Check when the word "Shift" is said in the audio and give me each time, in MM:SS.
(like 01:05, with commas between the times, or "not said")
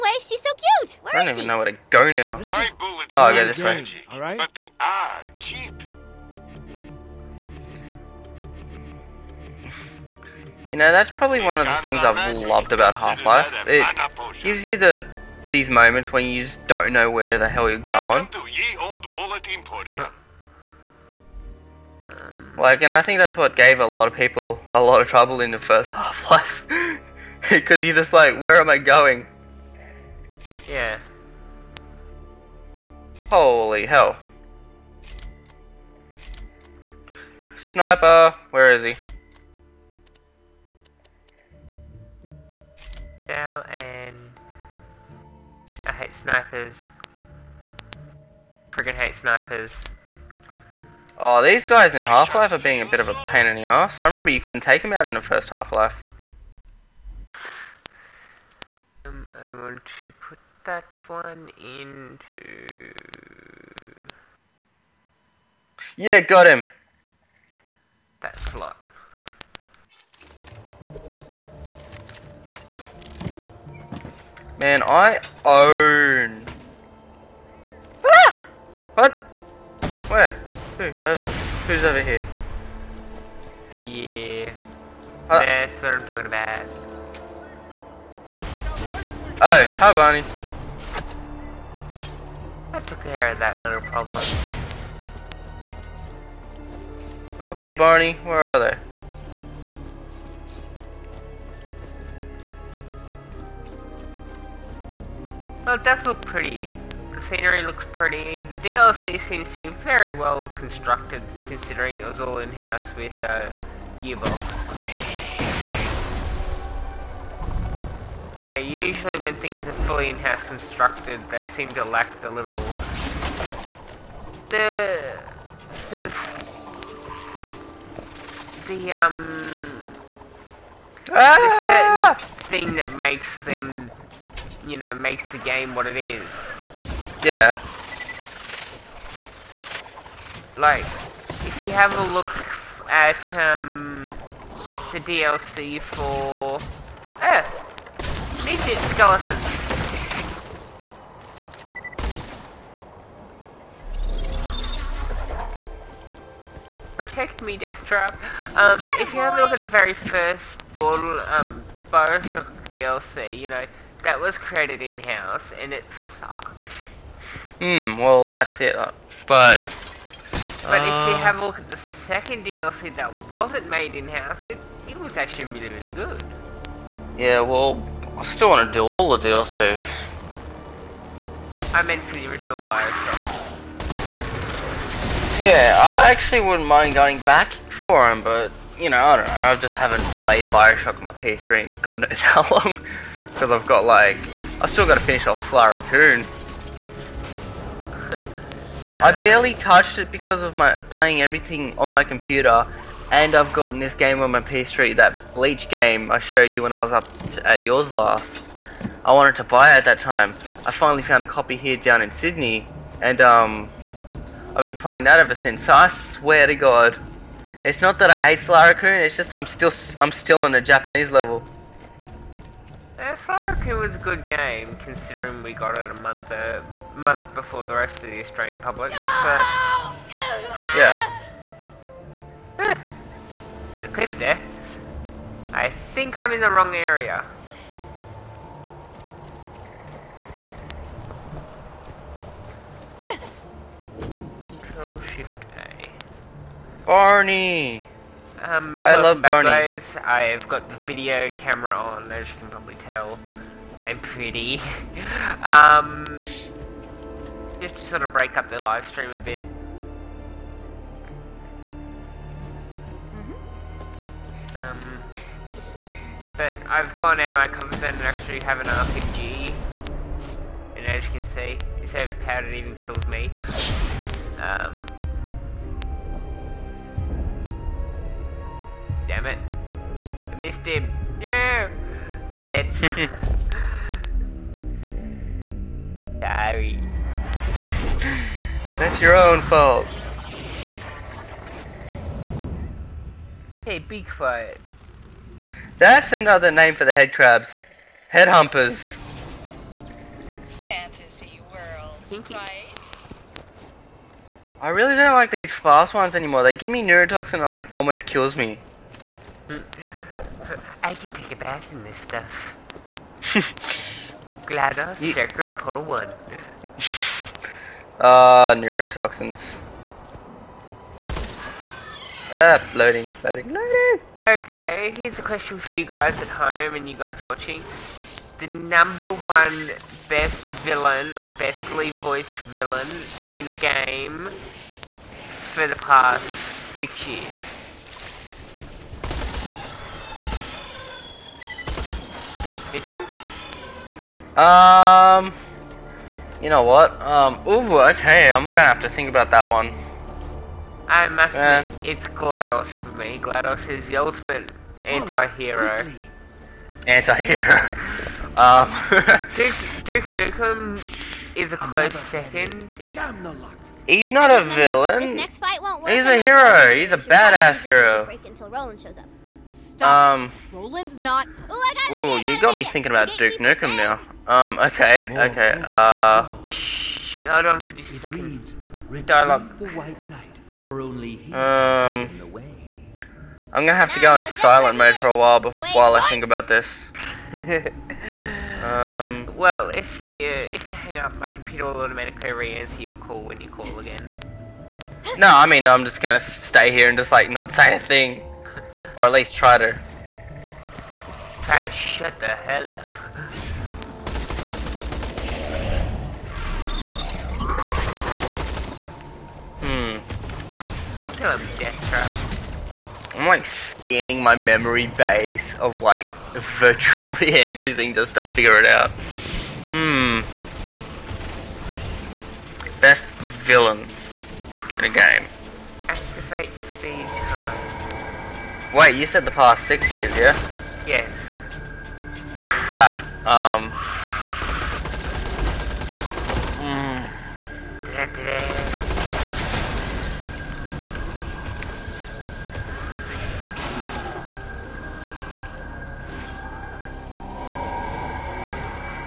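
04:04.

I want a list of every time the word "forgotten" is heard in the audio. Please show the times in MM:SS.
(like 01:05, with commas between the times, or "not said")
not said.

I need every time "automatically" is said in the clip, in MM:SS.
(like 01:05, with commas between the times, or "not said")
06:31.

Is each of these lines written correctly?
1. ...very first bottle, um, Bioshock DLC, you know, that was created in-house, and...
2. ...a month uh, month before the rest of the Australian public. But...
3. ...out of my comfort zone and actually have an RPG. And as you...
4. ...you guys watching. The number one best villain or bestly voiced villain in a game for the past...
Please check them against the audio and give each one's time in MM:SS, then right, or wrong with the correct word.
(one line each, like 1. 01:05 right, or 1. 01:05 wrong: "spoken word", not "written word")
1. 02:39 right
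2. 03:45 right
3. 04:27 right
4. 05:26 right.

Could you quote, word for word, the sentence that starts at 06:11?
Ooh, I got ooh, it, you got me thinking about Duke Nukem now.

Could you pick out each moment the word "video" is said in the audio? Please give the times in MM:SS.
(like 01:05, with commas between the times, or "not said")
04:10.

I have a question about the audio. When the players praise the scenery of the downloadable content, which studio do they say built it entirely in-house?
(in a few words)
Gearbox.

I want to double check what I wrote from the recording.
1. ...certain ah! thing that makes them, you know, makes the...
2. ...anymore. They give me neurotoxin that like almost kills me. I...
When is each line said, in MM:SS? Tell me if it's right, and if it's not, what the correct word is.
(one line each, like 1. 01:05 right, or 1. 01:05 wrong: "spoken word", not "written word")
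1. 02:11 right
2. 05:06 right.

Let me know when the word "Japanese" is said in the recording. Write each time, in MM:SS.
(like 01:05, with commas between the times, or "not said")
03:40.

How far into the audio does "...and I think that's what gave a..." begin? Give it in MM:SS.
00:22.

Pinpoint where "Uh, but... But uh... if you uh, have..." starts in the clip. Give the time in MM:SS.
02:48.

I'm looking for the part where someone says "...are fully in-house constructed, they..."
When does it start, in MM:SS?
01:59.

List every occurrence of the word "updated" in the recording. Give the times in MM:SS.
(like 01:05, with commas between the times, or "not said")
not said.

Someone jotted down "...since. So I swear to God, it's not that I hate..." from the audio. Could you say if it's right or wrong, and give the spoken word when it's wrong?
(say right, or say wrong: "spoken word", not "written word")
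right.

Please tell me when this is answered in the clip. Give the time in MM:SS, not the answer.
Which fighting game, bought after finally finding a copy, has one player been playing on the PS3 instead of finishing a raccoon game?
03:25.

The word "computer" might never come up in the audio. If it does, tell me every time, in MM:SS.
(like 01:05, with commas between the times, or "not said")
03:22, 06:31.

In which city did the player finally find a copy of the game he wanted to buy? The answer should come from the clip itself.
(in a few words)
Sydney.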